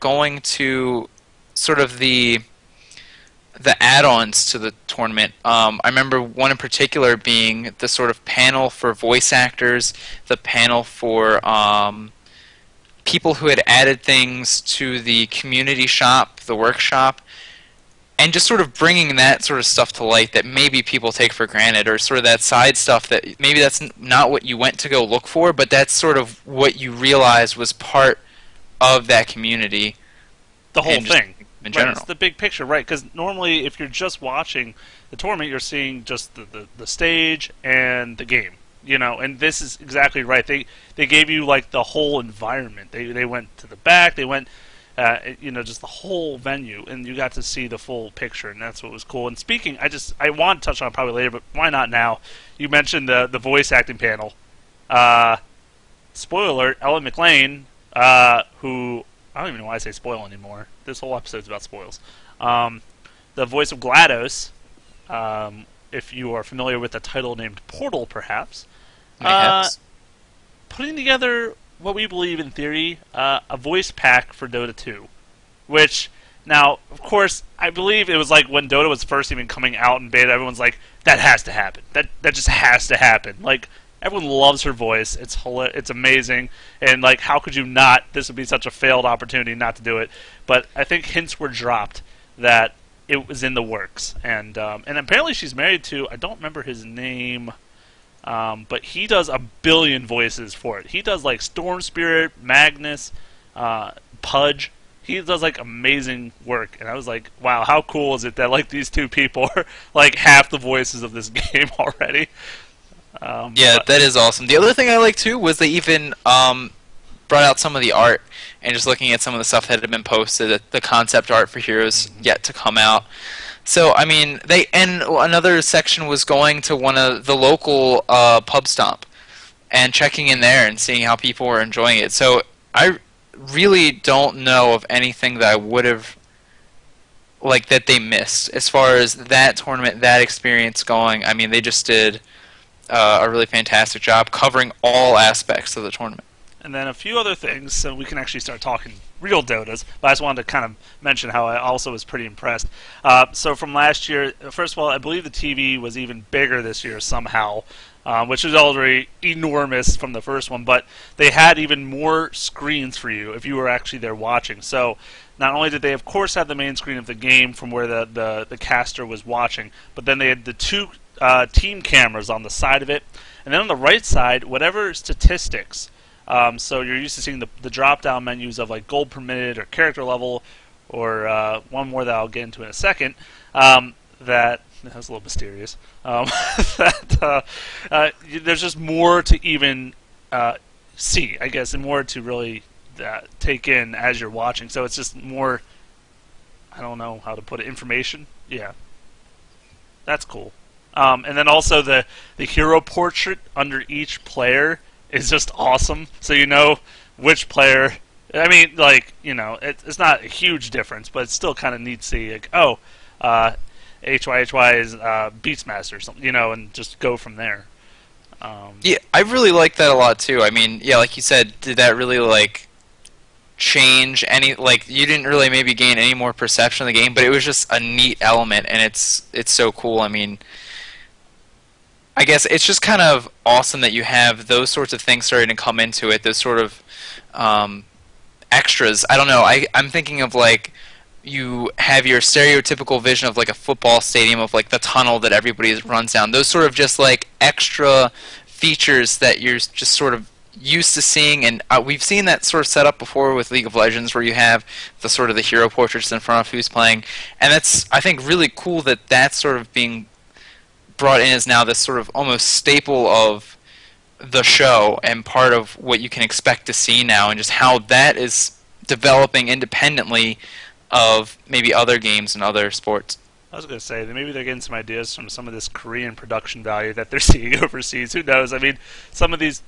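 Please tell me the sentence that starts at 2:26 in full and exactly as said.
And then a few other things, so we can actually start talking real Dotas.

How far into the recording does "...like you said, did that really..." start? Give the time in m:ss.
3:40.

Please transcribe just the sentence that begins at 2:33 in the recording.
Uh, so from last year, first of all, I believe the TV was even bigger this year somehow.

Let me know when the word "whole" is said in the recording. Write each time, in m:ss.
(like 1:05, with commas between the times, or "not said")
0:30, 0:41, 0:45, 1:00.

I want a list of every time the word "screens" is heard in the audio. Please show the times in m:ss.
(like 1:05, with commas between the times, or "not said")
2:42, 2:46.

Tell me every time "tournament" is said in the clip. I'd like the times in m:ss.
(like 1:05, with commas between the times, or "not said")
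0:04, 0:35, 2:19, 2:25.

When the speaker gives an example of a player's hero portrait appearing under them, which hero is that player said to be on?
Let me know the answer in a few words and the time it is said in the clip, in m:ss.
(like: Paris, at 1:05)
Beastmaster, at 3:35.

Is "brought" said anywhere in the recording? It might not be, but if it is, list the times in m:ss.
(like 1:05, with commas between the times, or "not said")
1:57, 4:20.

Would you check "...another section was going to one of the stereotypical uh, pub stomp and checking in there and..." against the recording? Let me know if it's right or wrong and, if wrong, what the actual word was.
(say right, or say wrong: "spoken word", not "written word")
wrong: "local", not "stereotypical".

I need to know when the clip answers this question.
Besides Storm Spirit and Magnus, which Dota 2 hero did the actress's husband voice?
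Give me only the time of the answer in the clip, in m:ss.
1:44.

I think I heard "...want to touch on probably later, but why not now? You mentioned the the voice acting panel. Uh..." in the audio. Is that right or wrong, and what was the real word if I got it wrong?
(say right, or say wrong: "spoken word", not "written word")
right.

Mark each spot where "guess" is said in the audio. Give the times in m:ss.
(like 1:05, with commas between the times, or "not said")
3:11, 3:52.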